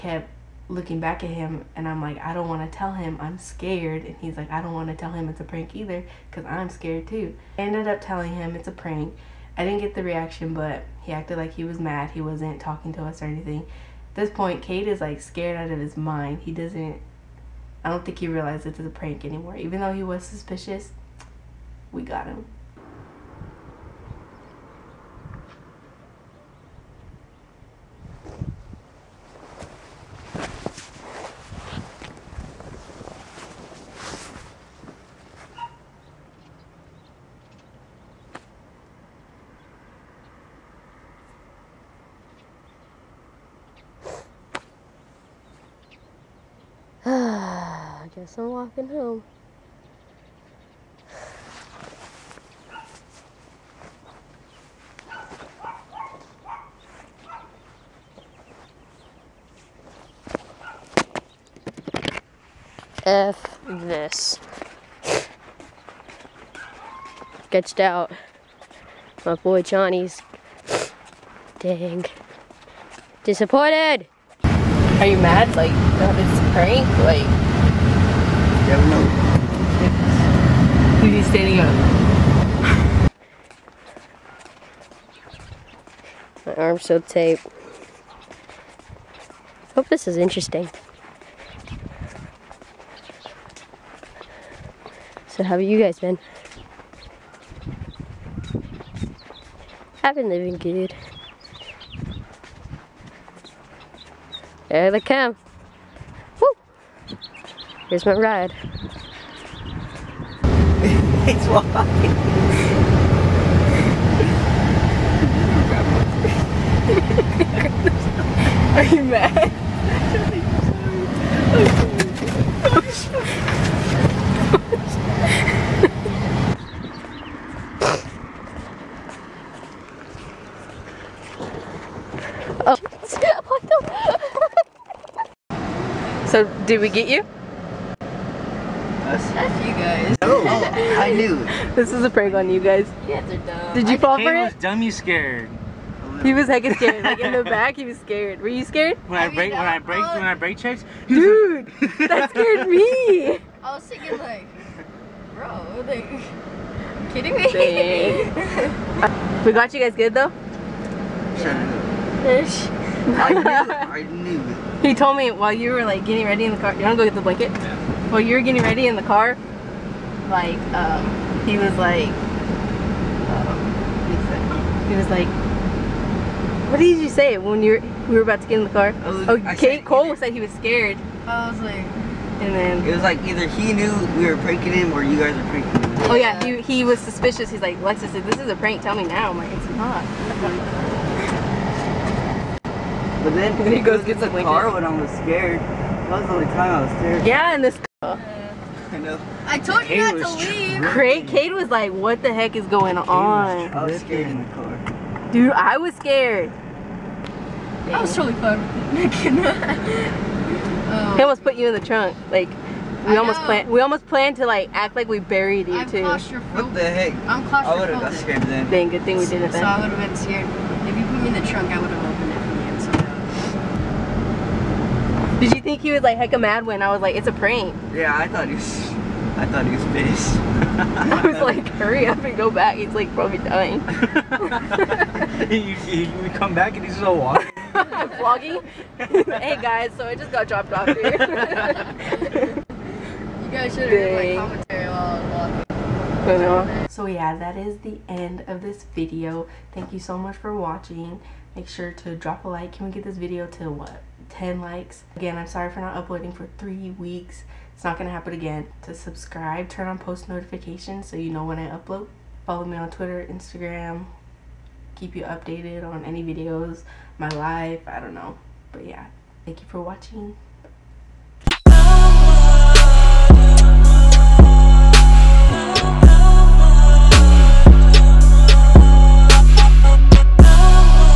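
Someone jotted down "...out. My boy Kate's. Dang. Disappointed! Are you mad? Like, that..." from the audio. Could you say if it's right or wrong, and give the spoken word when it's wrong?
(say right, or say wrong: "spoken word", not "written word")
wrong: "Johnny", not "Kate".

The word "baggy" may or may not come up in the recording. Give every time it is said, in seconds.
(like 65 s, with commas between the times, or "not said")
not said.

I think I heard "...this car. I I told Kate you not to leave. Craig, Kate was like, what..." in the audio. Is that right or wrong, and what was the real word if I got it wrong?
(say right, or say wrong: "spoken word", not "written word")
right.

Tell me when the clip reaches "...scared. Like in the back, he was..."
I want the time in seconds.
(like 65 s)
146 s.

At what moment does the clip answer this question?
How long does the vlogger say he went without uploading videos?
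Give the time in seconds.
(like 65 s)
256 s.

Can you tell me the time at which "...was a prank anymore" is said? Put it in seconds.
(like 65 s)
18 s.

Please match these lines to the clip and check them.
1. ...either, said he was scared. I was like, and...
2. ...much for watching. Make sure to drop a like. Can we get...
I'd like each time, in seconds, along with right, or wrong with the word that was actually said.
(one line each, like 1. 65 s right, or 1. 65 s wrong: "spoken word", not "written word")
1. 180 s right
2. 250 s right.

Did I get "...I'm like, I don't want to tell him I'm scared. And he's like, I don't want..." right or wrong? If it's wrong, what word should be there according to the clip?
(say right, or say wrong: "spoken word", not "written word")
right.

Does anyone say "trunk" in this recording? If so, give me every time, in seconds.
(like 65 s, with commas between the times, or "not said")
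211 s, 221 s.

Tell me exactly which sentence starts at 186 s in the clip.
Oh yeah, he he was suspicious.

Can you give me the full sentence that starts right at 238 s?
hey guys, so I just got dropped off here.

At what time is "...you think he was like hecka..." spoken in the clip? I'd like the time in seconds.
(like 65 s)
225 s.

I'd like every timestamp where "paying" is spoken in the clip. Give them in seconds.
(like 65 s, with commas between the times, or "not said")
not said.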